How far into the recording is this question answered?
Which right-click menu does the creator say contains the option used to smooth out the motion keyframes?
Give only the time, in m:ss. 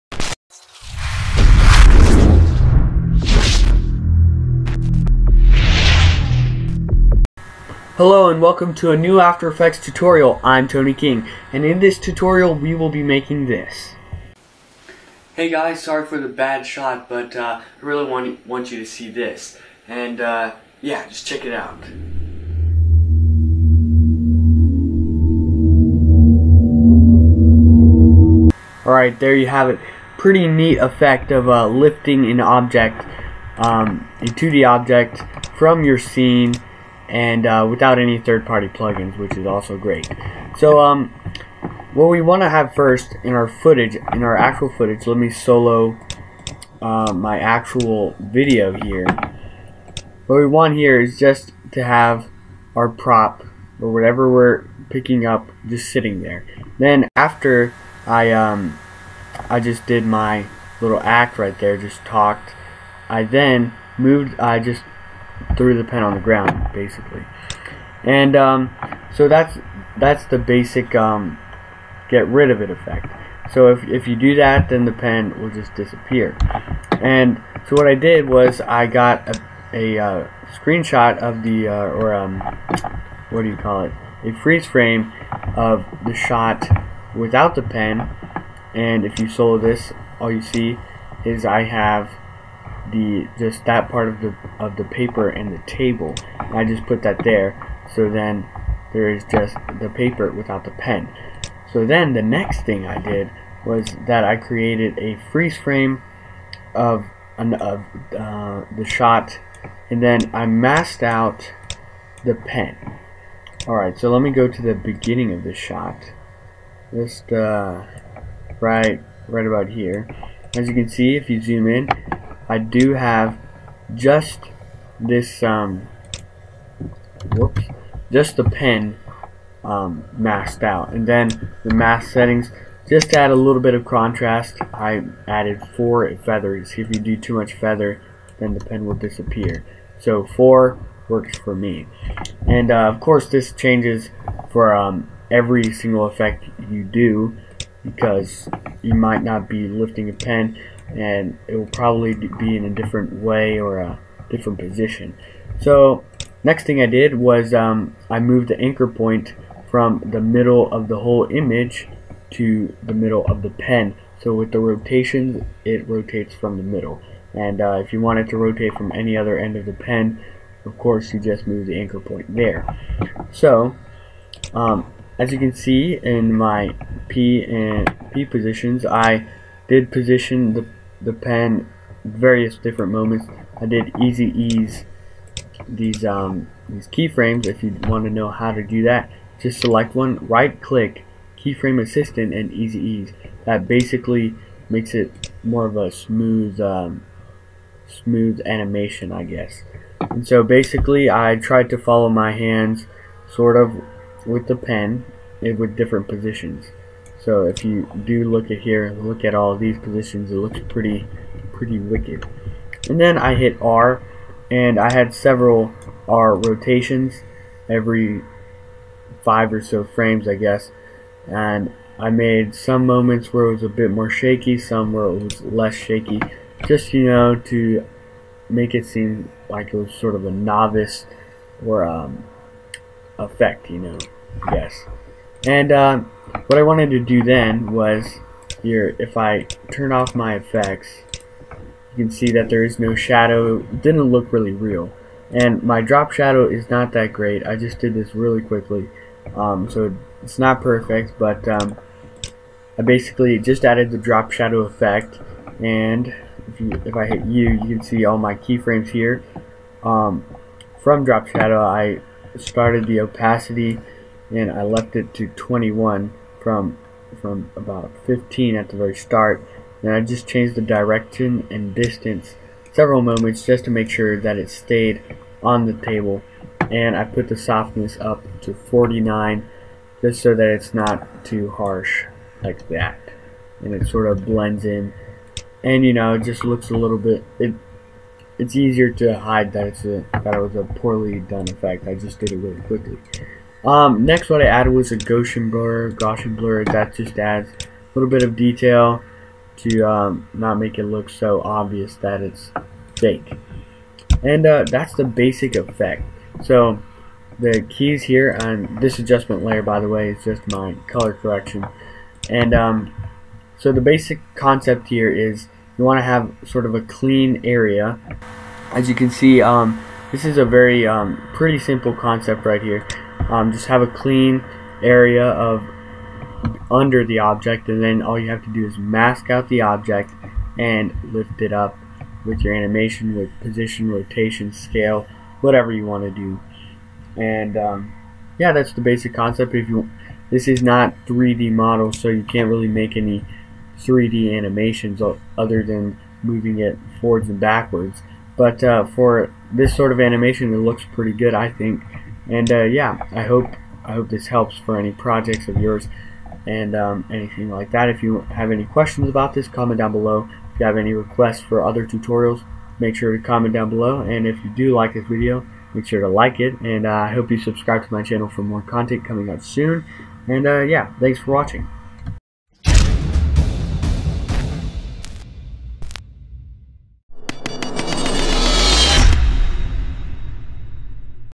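3:11.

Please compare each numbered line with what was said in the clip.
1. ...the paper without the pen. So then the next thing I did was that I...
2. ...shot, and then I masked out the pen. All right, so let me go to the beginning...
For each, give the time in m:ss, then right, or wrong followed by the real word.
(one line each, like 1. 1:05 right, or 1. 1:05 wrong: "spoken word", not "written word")
1. 1:39 right
2. 1:48 right.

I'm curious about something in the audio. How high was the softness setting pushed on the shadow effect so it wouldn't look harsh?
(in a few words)
49.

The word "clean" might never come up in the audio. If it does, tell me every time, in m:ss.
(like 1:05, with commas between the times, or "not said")
5:16, 5:23.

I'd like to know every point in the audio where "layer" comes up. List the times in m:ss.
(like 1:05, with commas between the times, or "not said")
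5:09.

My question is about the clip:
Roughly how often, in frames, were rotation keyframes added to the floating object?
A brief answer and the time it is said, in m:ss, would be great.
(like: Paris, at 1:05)
5, at 3:39.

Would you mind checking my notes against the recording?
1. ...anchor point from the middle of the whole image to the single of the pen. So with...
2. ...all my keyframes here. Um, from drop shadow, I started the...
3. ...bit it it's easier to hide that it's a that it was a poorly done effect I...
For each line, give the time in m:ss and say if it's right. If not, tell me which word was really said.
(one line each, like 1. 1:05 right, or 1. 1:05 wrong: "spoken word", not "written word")
1. 2:38 wrong: "middle", not "single"
2. 4:18 right
3. 4:46 right.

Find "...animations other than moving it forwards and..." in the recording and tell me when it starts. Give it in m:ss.
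5:44.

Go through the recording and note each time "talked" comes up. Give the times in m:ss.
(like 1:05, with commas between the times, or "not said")
1:02.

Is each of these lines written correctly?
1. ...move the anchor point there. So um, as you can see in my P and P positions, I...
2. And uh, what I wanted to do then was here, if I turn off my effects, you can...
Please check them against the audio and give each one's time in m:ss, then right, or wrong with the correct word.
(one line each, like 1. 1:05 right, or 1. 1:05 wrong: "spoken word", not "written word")
1. 2:51 right
2. 3:55 right.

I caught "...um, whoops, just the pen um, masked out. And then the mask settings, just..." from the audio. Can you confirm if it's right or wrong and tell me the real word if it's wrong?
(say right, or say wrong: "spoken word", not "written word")
right.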